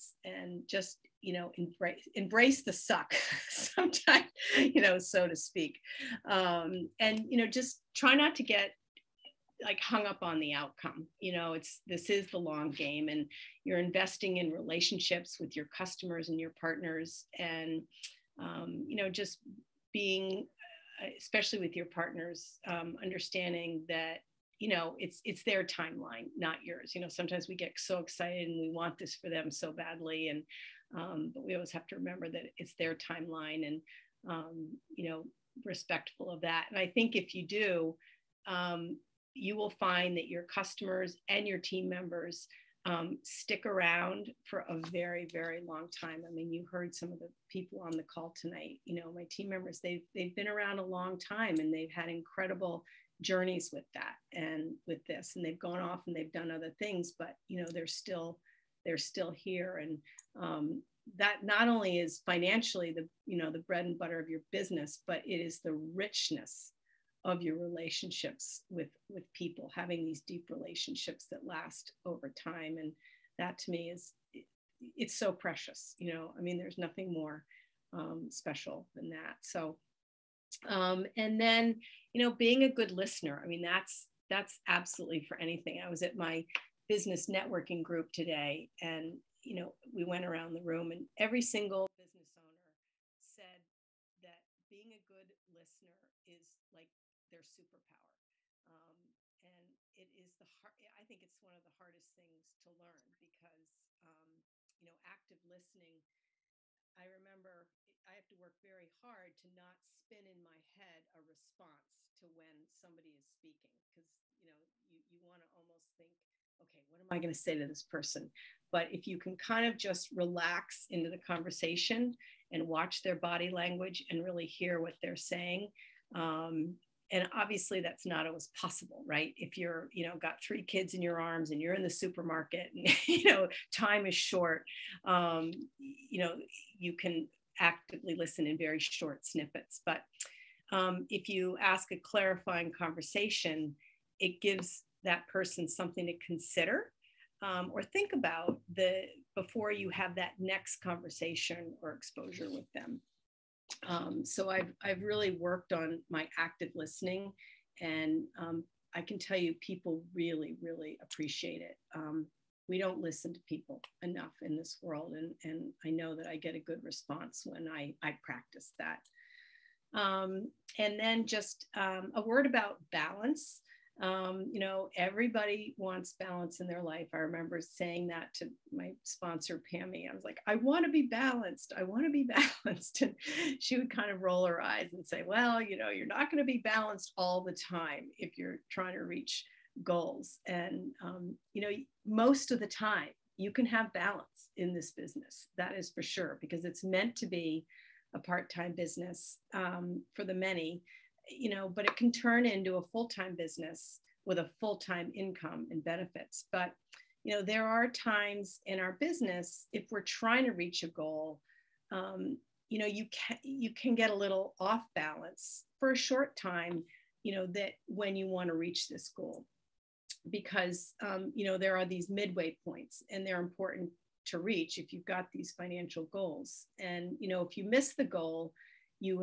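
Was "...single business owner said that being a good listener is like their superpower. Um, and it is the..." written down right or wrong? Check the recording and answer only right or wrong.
right.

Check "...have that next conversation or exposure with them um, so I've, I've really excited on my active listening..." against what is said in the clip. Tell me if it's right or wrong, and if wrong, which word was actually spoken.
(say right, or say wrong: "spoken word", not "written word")
wrong: "worked", not "excited".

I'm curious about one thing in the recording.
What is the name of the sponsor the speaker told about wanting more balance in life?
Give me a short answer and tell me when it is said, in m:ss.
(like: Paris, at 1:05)
Pammy, at 2:59.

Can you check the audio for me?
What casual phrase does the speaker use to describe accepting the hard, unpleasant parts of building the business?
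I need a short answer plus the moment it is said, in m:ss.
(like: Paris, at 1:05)
embrace the suck, at 0:02.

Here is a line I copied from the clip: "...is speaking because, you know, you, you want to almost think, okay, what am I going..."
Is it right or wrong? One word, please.
right.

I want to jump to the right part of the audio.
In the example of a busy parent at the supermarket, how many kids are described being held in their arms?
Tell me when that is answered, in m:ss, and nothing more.
2:10.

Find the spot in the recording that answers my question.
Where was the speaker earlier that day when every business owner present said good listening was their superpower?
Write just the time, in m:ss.
1:26.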